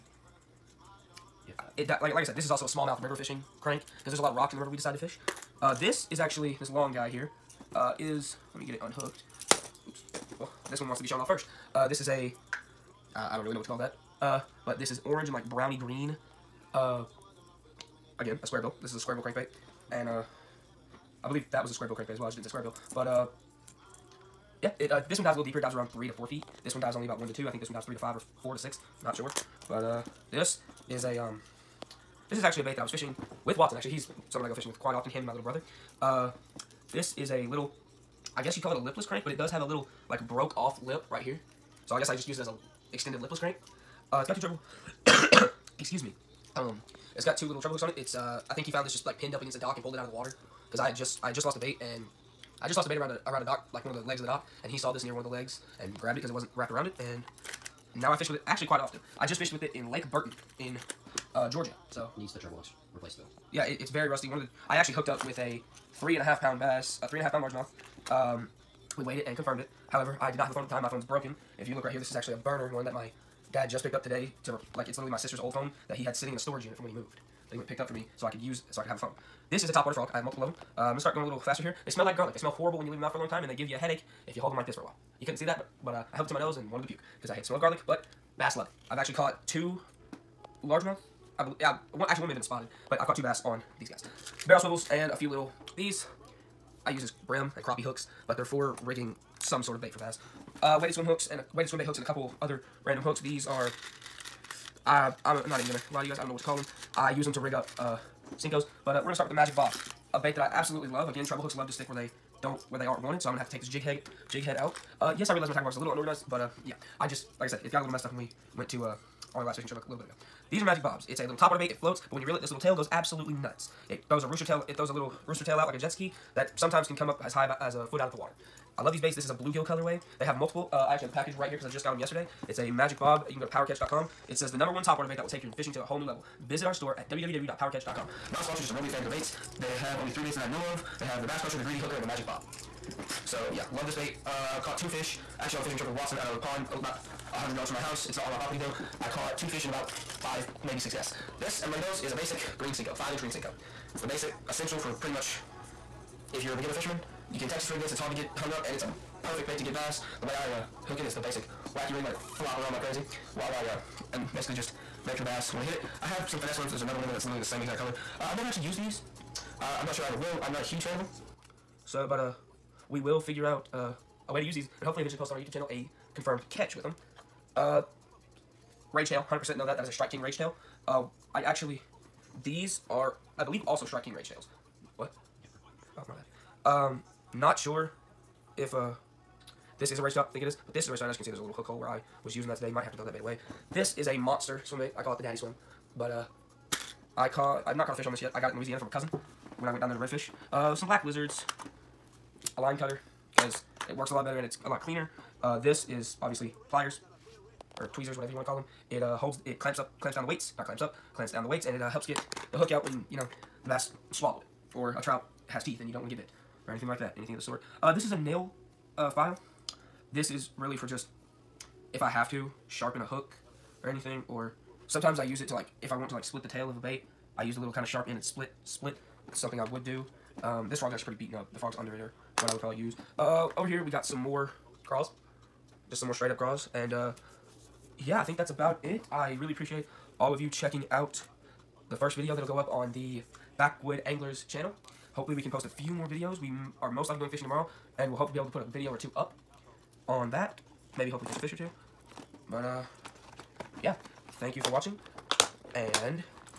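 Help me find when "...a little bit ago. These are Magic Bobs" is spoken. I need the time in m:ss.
1:59.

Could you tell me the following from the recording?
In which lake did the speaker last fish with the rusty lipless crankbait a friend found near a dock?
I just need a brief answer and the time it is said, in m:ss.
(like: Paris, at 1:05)
Lake Burton, at 0:59.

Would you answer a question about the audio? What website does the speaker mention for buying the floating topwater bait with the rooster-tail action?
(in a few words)
powercatch.com.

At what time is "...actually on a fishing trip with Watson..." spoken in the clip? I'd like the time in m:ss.
2:25.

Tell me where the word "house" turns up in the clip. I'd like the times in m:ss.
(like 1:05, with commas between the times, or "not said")
2:27.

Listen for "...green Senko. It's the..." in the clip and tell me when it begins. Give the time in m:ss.
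2:33.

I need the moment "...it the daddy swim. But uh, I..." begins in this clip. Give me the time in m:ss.
3:15.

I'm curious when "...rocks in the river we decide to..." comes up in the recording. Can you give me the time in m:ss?
0:04.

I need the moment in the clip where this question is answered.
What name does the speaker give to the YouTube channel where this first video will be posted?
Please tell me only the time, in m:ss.
4:03.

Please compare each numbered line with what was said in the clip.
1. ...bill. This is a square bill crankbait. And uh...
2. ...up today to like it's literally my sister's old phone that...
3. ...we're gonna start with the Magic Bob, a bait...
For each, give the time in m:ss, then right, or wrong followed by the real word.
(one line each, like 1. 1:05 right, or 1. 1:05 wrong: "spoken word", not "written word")
1. 0:18 right
2. 1:13 right
3. 1:49 right.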